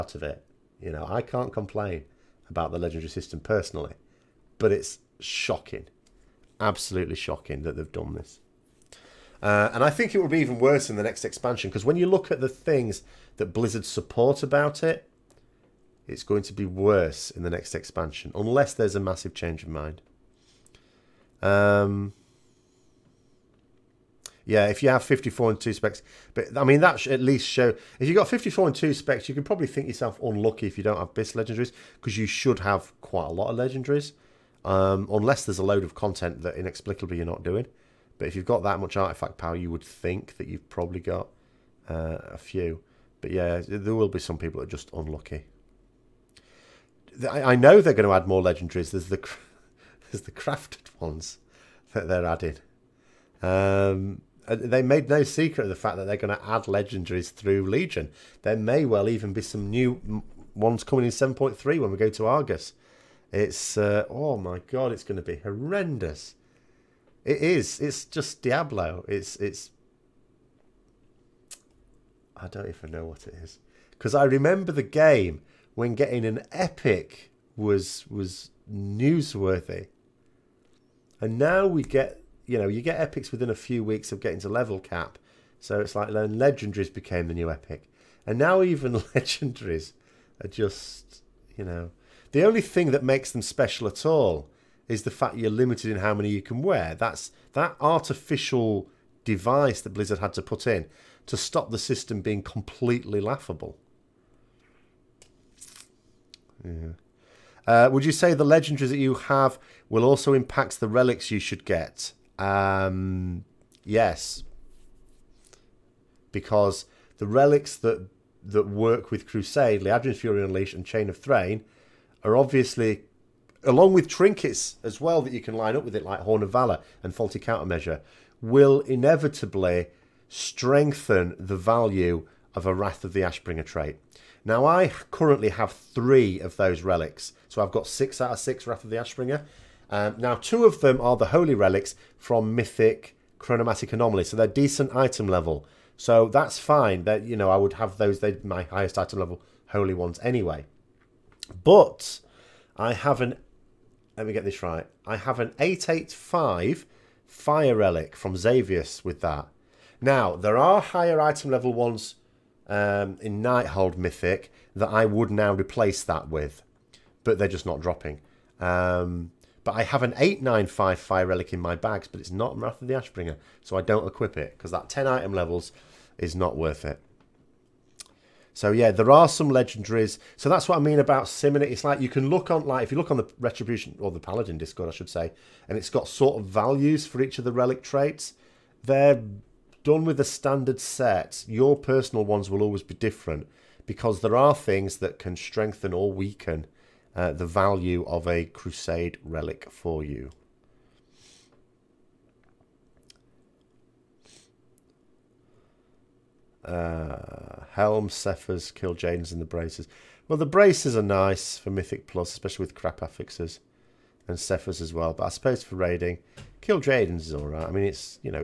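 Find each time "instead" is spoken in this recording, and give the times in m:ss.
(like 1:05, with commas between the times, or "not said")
not said.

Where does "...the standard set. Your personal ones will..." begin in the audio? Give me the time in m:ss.
3:10.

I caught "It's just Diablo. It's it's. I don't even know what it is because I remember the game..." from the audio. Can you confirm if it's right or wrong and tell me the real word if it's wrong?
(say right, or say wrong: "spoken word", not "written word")
right.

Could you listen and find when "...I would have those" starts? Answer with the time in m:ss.
2:27.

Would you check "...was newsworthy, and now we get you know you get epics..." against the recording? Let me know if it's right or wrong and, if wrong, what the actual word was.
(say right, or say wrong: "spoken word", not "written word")
right.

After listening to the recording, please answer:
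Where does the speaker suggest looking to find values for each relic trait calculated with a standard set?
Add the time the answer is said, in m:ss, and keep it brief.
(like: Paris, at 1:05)
Paladin Discord, at 3:04.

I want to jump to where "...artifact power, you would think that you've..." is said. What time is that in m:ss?
0:38.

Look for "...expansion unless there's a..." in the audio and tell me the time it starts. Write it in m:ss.
0:17.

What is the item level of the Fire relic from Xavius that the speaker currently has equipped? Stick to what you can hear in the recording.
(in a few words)
885.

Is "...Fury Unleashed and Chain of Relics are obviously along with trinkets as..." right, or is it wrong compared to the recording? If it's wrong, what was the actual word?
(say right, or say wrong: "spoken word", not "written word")
wrong: "Thrayn", not "Relics".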